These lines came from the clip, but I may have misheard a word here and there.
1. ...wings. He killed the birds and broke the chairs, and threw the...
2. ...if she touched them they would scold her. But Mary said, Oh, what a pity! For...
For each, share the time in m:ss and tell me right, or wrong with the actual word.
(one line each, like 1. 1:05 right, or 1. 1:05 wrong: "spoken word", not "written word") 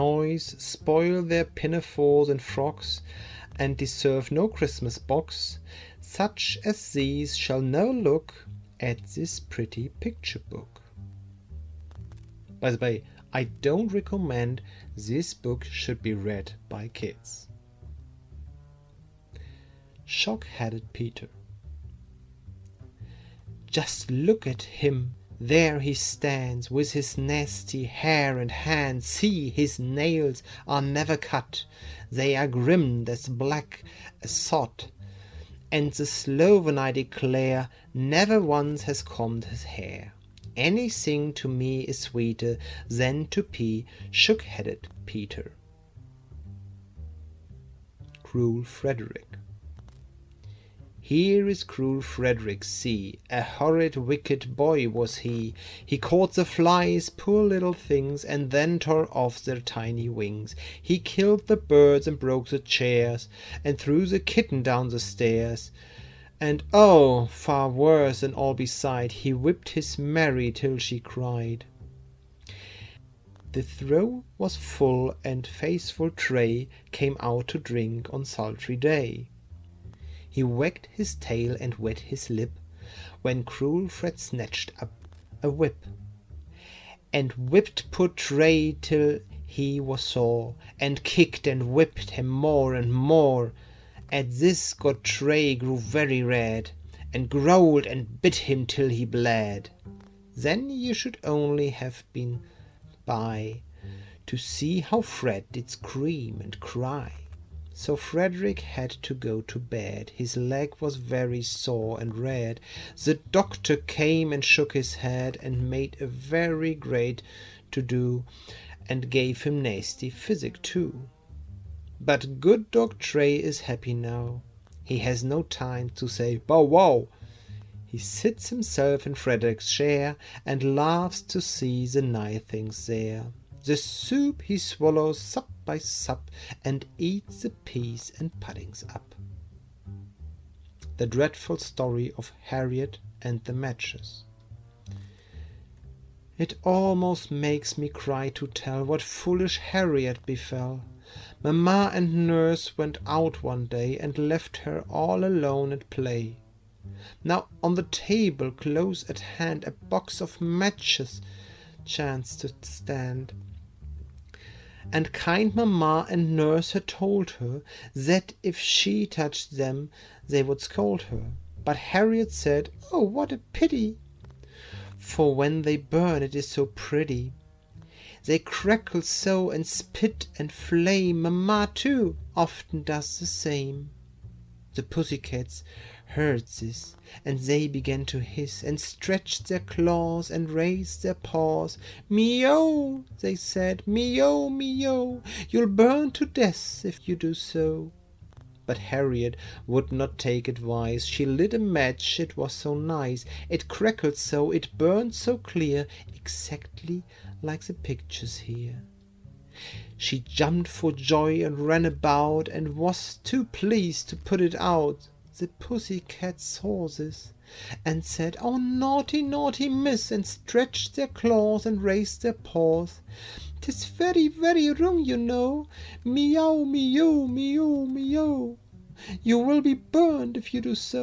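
1. 1:00 right
2. 2:48 wrong: "Harriet", not "Mary".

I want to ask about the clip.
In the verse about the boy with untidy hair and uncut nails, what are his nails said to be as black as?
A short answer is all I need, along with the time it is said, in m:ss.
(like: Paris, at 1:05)
sod, at 0:34.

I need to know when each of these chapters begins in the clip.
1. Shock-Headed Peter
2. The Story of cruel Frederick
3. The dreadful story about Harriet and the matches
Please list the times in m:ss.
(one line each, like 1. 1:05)
1. 0:18
2. 0:47
3. 2:19.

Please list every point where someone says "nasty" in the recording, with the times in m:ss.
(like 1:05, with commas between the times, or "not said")
0:27, 1:59.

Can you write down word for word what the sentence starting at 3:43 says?
Tis very, very wrong, you know.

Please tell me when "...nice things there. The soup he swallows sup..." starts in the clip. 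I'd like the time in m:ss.
2:12.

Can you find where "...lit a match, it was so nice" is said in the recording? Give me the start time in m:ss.
3:21.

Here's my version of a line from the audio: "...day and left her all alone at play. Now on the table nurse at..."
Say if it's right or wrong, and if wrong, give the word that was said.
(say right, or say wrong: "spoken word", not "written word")
wrong: "close", not "nurse".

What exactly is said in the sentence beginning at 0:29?
See, his nails are never cut.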